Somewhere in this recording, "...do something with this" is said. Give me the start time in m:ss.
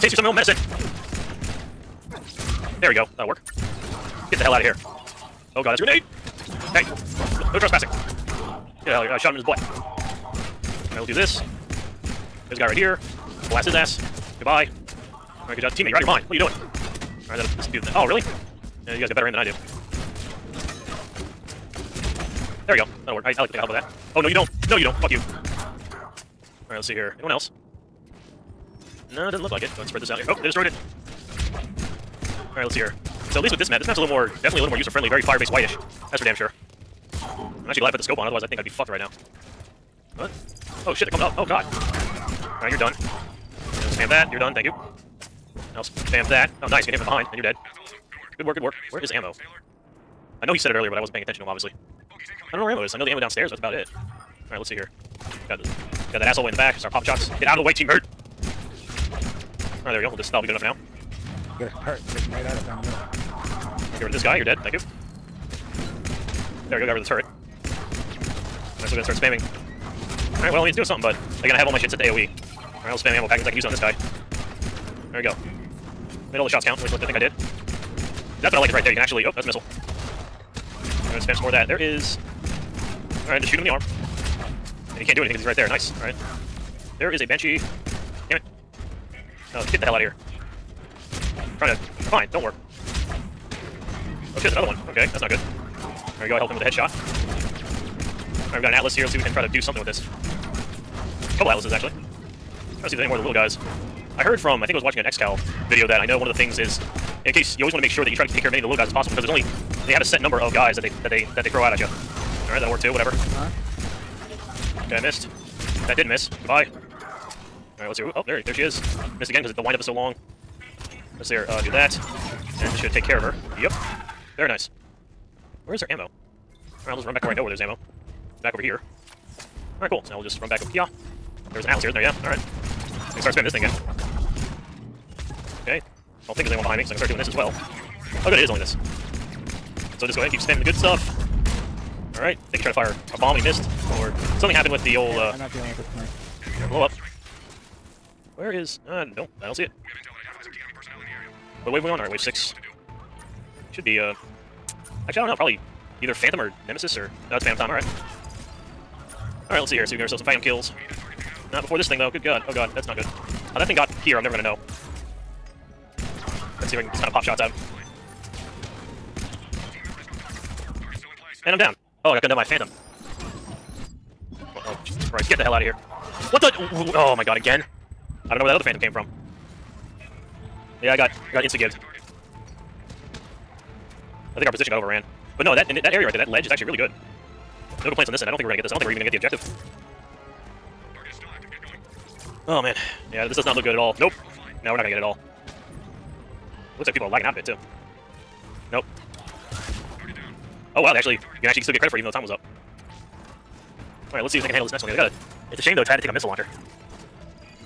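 1:39.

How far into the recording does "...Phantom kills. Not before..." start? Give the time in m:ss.
2:40.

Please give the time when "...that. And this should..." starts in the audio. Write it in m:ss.
2:01.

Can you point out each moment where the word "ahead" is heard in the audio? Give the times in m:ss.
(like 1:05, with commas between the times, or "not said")
0:29, 2:20.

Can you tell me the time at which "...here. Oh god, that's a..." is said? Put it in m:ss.
0:04.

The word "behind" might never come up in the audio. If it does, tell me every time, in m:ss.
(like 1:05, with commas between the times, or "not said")
0:47, 2:16.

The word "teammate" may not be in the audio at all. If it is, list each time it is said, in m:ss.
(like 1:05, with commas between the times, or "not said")
0:15, 0:57.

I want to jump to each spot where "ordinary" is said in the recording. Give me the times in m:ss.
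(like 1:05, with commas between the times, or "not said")
not said.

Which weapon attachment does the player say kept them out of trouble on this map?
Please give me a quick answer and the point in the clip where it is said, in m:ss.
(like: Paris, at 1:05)
scope, at 0:38.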